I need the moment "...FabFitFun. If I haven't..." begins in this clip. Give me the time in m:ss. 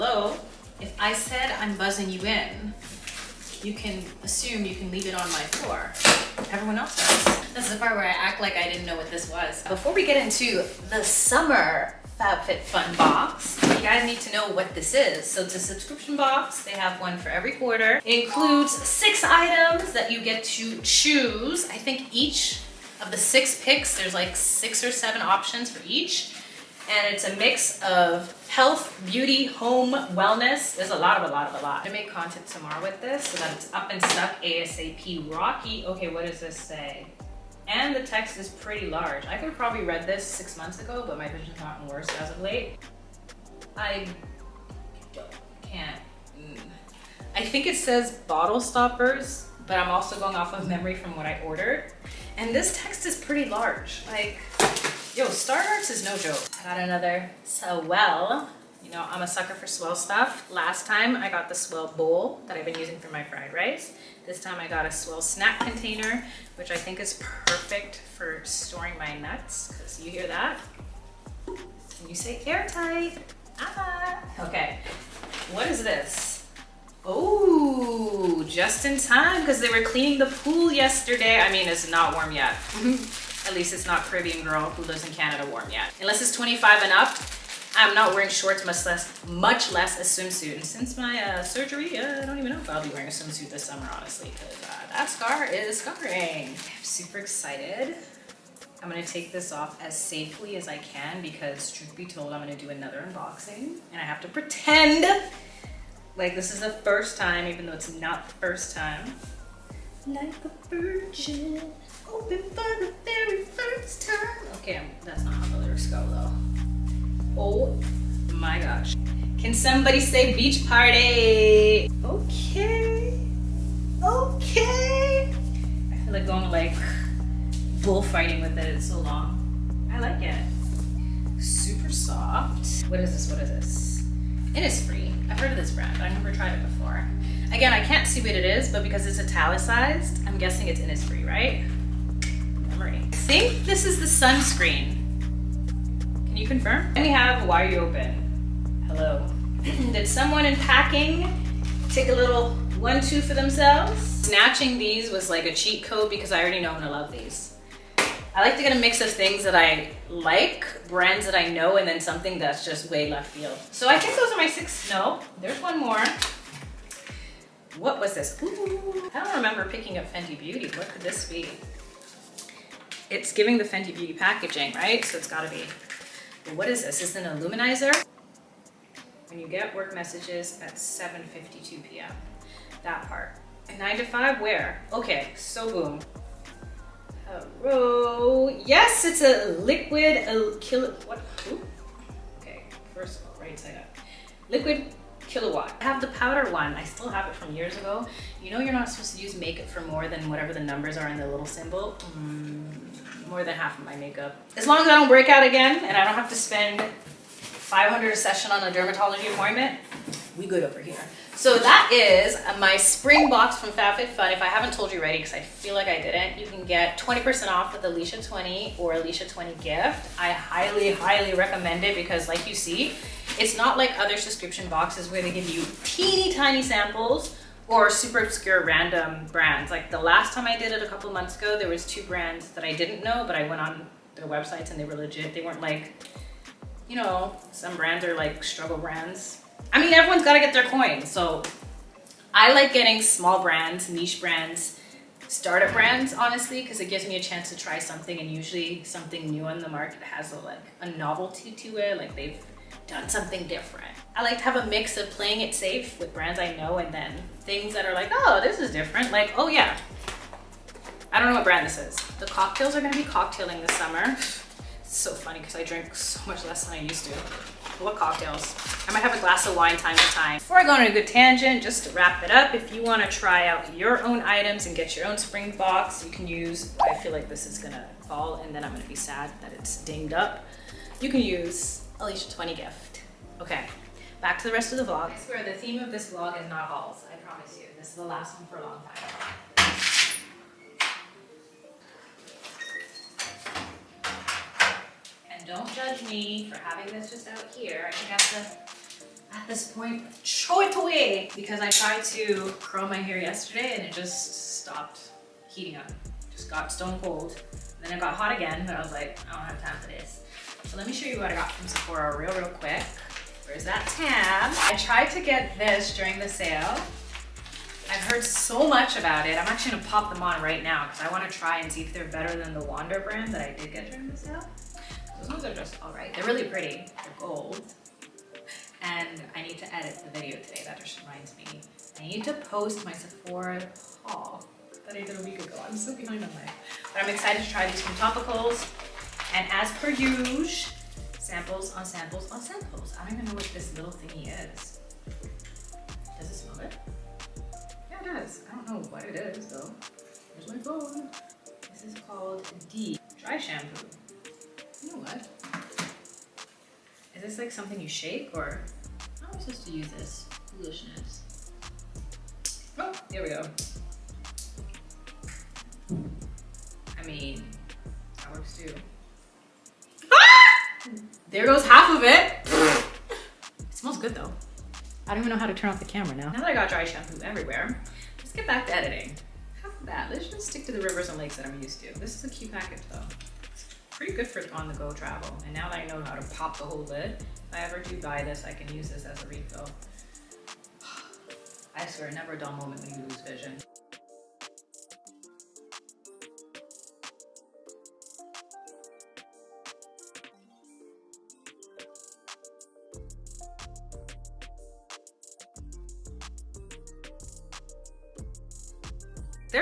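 3:33.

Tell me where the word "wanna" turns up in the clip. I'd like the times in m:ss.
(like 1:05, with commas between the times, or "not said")
4:32, 5:21.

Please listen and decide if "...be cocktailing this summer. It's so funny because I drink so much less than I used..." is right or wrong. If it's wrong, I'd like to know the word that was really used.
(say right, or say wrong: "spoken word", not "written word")
right.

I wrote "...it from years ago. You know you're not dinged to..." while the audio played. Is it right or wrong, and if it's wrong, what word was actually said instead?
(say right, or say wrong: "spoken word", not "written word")
wrong: "supposed", not "dinged".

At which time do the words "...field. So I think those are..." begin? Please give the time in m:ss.
2:43.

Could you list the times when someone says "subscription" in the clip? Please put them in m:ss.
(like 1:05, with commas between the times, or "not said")
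0:15, 3:44.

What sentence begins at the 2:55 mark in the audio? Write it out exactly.
So it's gotta be, well, what is this?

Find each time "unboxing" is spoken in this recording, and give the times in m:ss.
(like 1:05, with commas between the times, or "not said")
1:43.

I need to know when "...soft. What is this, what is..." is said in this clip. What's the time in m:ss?
2:11.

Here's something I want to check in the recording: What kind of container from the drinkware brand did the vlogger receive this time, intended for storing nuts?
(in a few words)
Swell snack container.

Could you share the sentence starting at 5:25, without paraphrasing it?
Those ones are just all right.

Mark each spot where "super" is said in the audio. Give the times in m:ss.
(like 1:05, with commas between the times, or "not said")
1:36, 2:11, 3:47.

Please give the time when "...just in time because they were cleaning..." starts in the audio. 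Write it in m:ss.
1:18.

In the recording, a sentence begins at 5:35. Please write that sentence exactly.
I'm so behind on life, But I'm excited to try these from Topicals.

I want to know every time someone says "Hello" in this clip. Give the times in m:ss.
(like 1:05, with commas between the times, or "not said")
2:28, 3:07.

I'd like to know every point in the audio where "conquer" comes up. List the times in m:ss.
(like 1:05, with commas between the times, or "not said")
not said.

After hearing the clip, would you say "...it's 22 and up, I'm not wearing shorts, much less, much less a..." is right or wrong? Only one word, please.
wrong.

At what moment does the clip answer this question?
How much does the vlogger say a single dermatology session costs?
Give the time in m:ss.
3:27.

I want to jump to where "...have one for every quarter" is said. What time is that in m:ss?
0:16.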